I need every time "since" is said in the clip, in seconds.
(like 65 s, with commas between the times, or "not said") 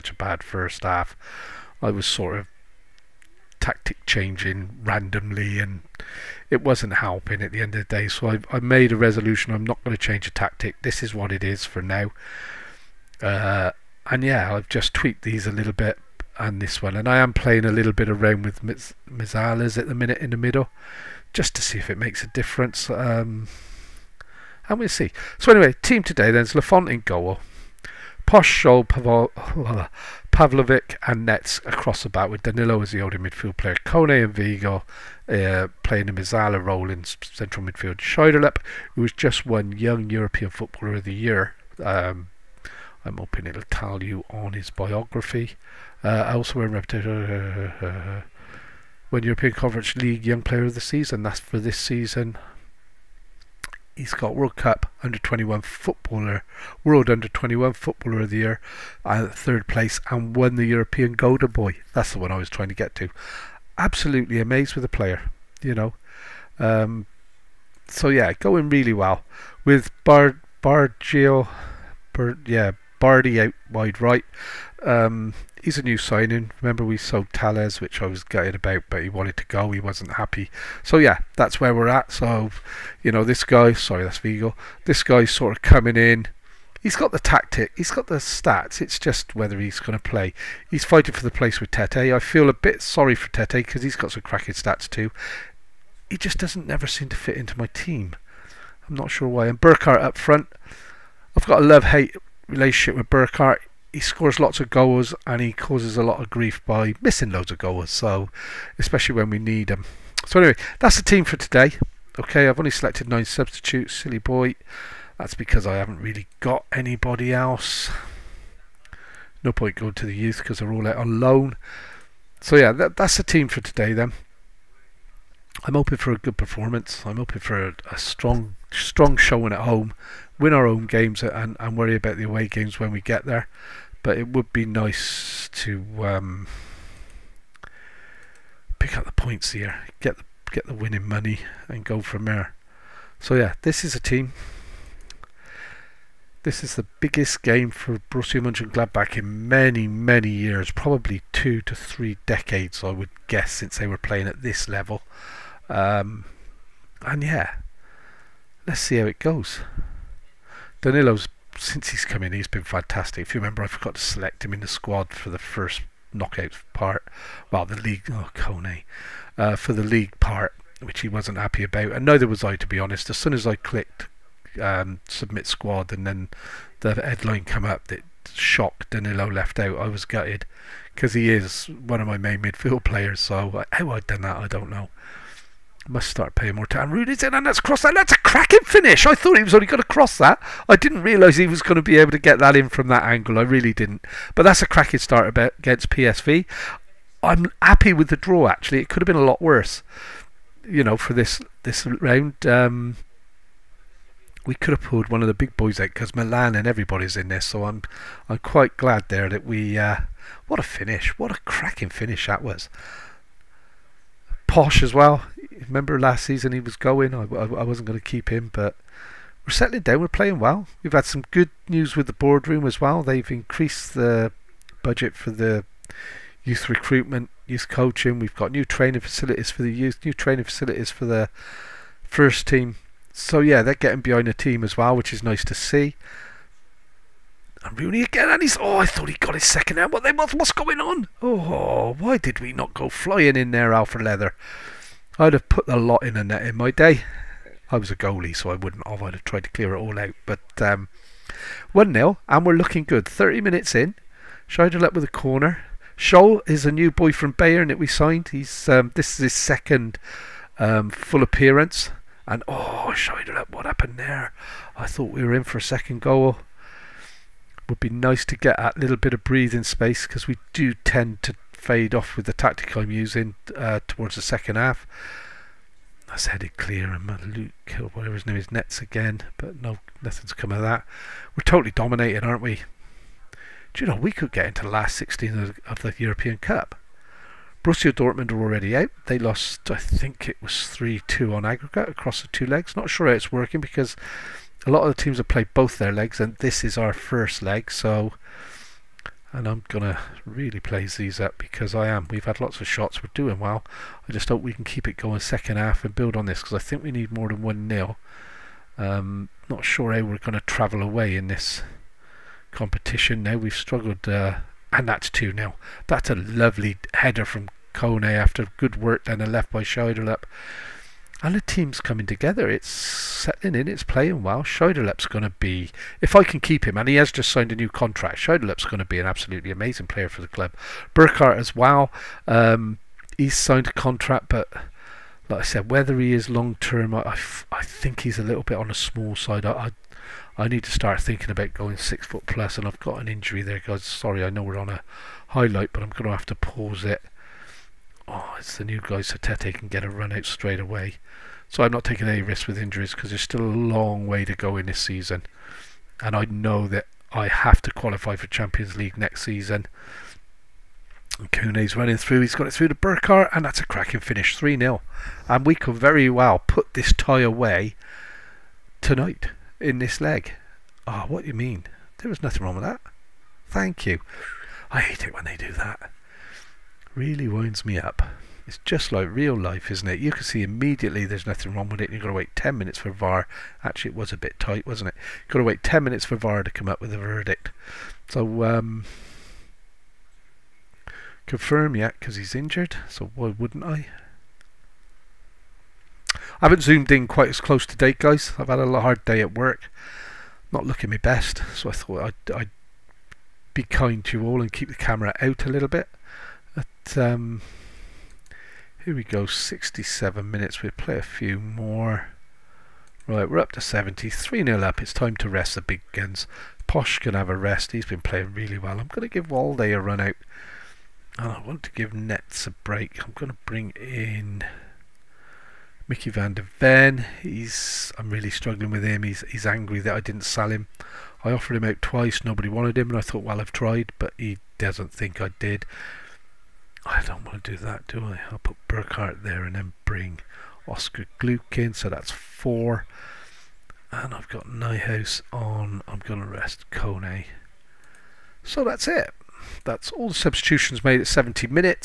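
153 s, 161 s.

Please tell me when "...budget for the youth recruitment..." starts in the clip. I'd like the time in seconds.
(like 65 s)
224 s.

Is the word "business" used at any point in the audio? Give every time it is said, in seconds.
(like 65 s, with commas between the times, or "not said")
not said.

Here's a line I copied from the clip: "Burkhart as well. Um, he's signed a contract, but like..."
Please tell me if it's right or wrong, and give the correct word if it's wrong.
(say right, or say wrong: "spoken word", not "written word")
right.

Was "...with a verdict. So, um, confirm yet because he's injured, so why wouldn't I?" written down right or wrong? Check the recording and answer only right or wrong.
right.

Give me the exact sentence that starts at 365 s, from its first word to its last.
And we could very well put this tie away tonight in this leg.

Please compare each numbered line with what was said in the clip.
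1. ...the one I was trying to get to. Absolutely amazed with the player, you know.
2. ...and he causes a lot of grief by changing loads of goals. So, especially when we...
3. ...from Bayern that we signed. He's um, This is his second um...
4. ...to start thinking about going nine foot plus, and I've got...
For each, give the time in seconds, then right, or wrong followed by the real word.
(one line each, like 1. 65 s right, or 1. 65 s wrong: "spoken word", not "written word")
1. 62 s right
2. 105 s wrong: "missing", not "changing"
3. 257 s right
4. 340 s wrong: "six", not "nine".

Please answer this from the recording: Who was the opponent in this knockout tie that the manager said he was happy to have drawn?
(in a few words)
PSV.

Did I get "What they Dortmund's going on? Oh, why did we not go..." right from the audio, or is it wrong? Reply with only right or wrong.
wrong.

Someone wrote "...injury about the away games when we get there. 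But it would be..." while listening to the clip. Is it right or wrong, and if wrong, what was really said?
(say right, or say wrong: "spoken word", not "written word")
wrong: "worry", not "injury".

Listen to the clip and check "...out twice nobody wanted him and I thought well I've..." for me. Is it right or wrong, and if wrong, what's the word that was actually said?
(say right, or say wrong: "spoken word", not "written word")
right.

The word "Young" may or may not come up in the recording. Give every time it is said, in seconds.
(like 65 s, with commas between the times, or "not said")
39 s, 50 s.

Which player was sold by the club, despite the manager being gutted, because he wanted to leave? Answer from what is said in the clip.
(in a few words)
Tales.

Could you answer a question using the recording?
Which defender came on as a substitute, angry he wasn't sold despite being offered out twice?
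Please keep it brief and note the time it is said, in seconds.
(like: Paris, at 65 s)
Micky van de Ven, at 425 s.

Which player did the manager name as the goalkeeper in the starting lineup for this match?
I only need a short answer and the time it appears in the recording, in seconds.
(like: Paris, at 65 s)
Lafont, at 26 s.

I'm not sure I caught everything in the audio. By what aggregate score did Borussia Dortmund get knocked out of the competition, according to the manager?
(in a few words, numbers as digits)
3-2.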